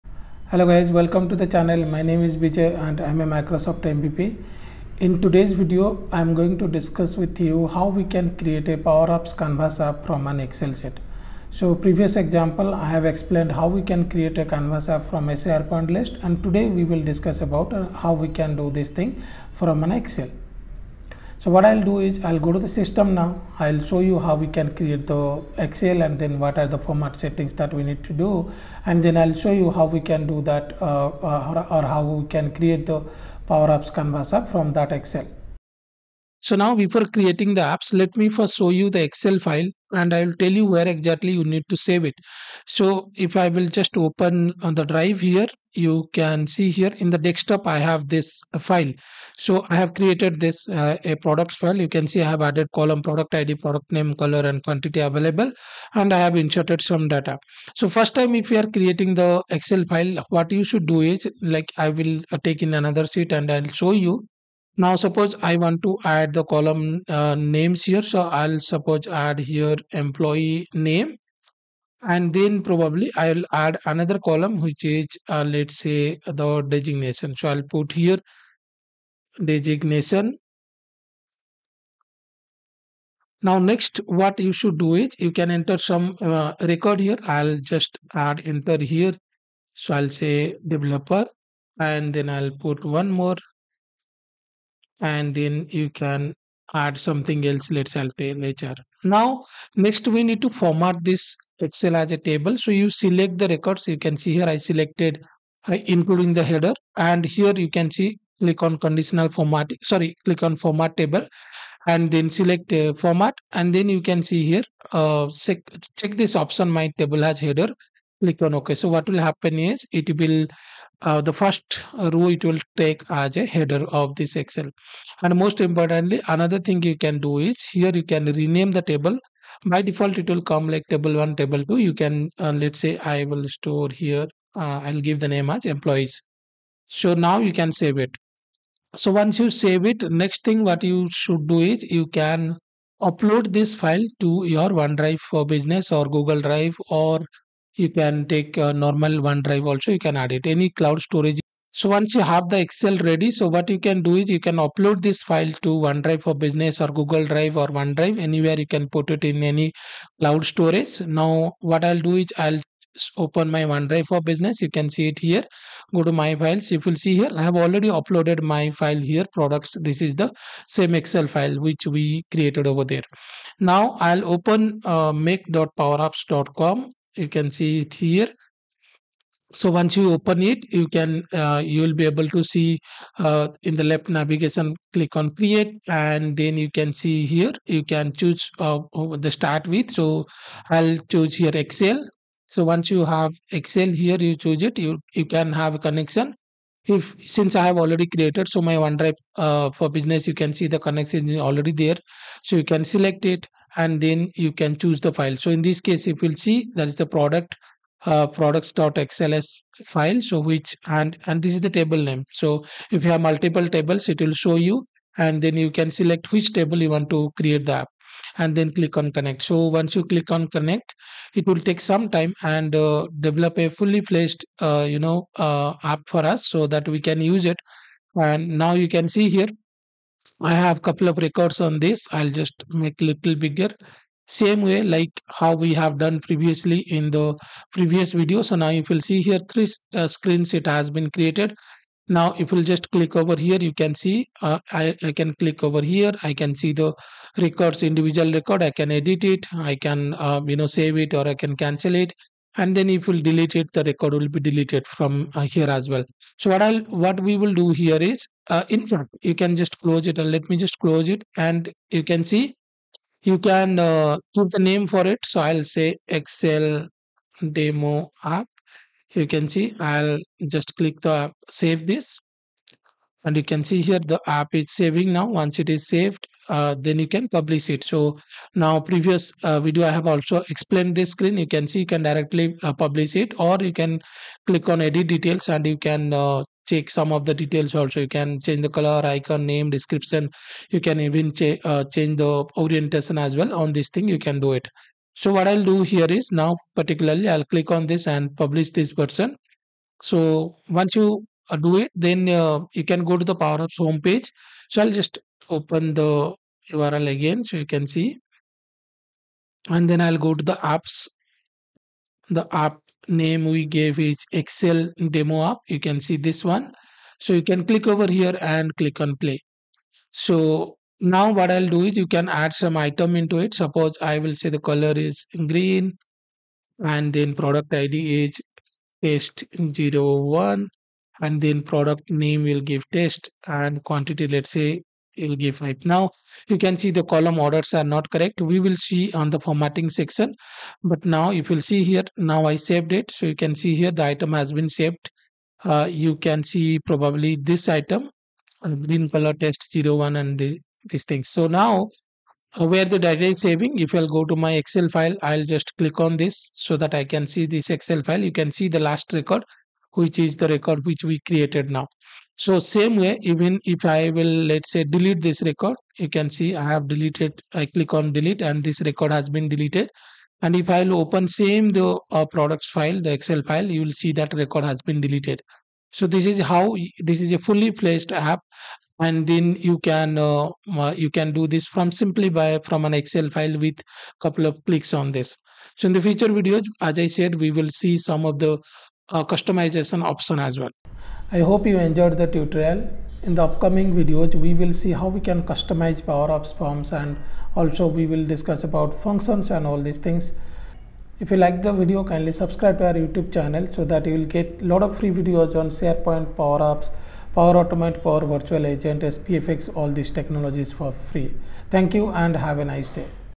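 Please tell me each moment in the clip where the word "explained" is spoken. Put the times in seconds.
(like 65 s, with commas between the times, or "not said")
13 s, 280 s.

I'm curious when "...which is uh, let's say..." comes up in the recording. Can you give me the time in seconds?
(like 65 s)
74 s.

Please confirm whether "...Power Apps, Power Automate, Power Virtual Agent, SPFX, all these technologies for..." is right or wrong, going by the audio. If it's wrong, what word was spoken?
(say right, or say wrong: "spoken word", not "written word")
right.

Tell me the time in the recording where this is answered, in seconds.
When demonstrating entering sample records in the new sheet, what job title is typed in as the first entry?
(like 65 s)
90 s.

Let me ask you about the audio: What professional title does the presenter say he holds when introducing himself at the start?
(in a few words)
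Microsoft MVP.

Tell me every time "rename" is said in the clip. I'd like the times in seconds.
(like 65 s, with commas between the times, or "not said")
128 s.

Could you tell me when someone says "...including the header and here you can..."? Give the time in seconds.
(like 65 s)
105 s.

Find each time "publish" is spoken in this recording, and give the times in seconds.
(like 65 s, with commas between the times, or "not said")
277 s, 282 s, 298 s.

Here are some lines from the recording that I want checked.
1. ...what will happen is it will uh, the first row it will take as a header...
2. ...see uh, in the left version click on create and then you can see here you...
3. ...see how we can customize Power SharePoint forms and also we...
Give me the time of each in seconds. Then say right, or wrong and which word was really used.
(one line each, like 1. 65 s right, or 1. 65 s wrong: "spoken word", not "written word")
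1. 118 s right
2. 182 s wrong: "navigation", not "version"
3. 394 s wrong: "Apps", not "SharePoint".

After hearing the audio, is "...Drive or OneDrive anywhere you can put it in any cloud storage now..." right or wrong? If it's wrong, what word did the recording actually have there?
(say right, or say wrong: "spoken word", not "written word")
right.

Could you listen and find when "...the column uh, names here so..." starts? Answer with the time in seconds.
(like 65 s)
66 s.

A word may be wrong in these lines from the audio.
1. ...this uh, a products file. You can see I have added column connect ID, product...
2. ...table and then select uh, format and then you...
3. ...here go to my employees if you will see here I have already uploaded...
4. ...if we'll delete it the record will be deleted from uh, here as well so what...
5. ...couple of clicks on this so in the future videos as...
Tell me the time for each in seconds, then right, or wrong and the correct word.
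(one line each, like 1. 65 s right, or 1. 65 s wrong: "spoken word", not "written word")
1. 50 s wrong: "product", not "connect"
2. 110 s right
3. 165 s wrong: "files", not "employees"
4. 252 s right
5. 384 s right.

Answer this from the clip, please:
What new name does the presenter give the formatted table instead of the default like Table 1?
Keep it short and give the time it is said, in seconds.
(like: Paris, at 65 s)
employees, at 135 s.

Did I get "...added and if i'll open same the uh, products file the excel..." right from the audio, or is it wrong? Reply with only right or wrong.
wrong.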